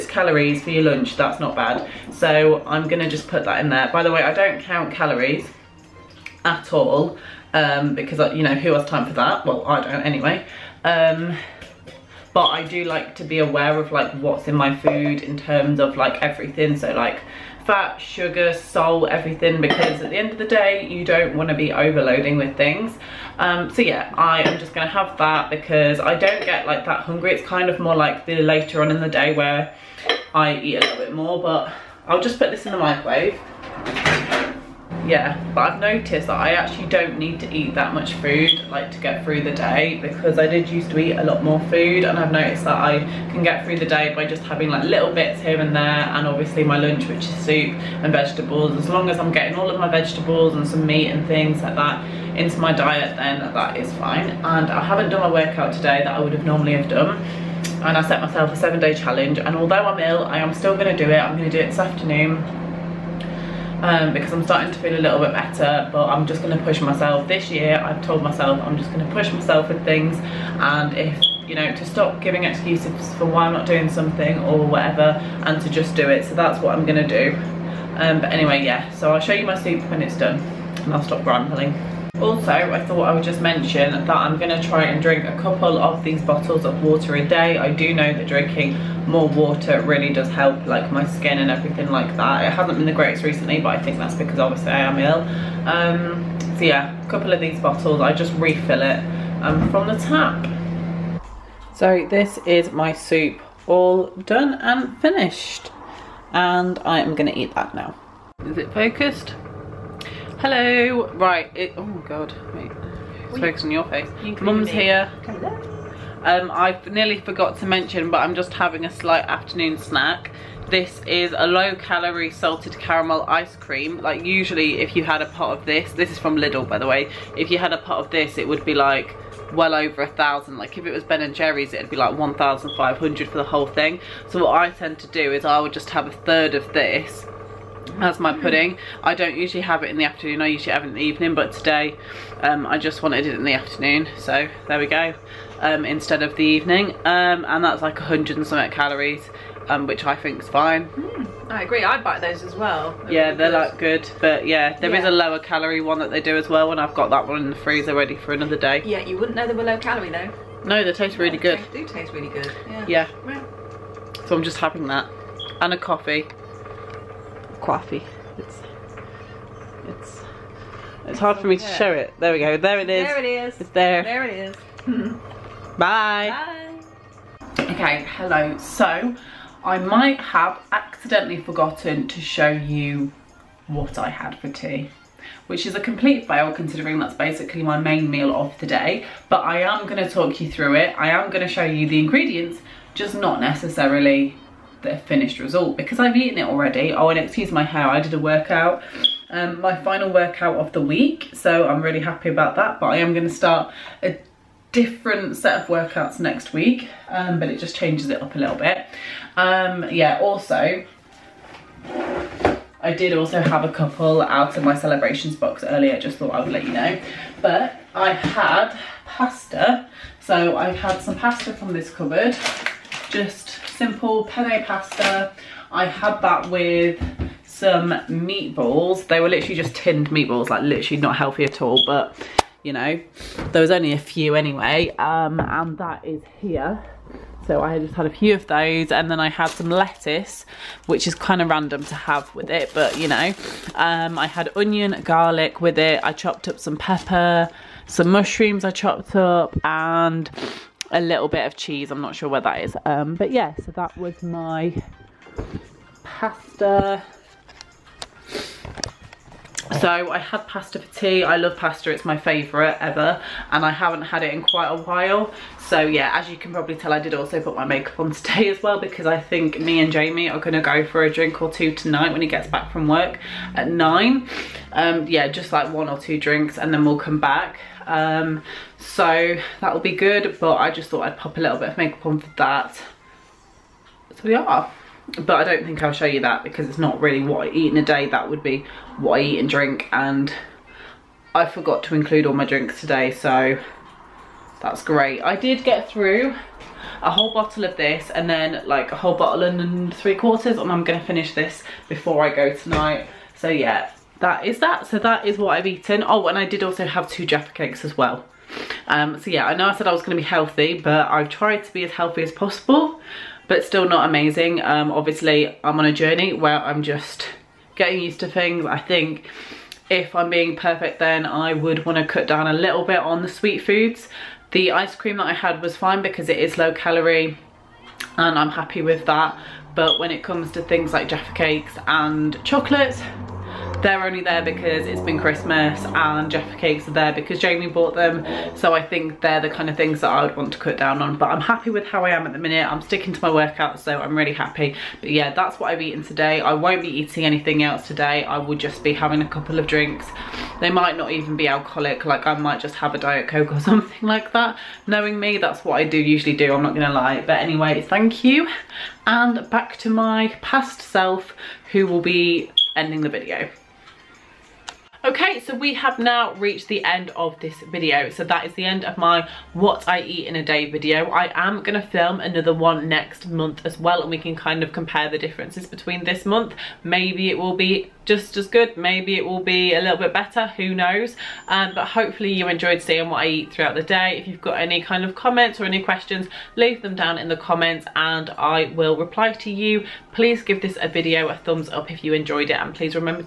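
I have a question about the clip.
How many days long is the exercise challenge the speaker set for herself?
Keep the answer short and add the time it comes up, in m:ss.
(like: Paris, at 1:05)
7, at 0:58.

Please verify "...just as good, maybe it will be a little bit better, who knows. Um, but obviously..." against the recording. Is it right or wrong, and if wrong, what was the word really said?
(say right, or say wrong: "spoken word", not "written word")
wrong: "hopefully", not "obviously".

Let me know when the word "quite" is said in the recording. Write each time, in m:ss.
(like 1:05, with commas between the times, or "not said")
4:24.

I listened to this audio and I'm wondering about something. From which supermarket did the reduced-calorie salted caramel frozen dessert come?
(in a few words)
Lidl.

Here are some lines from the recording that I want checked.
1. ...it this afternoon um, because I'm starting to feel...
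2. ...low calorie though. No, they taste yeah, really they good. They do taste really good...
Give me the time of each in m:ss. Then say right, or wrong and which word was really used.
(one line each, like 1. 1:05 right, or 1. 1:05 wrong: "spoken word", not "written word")
1. 1:01 right
2. 2:39 right.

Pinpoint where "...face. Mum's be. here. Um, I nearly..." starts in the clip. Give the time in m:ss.
1:53.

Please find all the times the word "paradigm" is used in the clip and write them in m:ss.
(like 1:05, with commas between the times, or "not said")
not said.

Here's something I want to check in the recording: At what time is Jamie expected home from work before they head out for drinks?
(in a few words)
9.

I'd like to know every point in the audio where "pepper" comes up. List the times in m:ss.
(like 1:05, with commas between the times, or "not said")
4:06.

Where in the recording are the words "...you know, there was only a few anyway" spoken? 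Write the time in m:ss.
3:52.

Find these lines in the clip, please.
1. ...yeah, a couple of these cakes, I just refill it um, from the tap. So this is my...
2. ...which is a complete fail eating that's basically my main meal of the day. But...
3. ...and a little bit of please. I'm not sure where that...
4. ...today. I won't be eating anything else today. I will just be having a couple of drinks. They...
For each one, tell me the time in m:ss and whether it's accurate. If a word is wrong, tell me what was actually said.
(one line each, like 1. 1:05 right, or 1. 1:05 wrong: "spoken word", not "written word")
1. 1:36 wrong: "bottles", not "cakes"
2. 3:05 wrong: "considering", not "eating"
3. 4:09 wrong: "cheese", not "please"
4. 5:46 right.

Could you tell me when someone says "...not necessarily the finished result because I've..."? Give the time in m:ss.
3:13.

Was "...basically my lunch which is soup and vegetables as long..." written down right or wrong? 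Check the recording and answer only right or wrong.
wrong.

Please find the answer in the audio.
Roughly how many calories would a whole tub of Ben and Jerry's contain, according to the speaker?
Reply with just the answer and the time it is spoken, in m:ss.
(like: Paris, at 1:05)
1500, at 2:12.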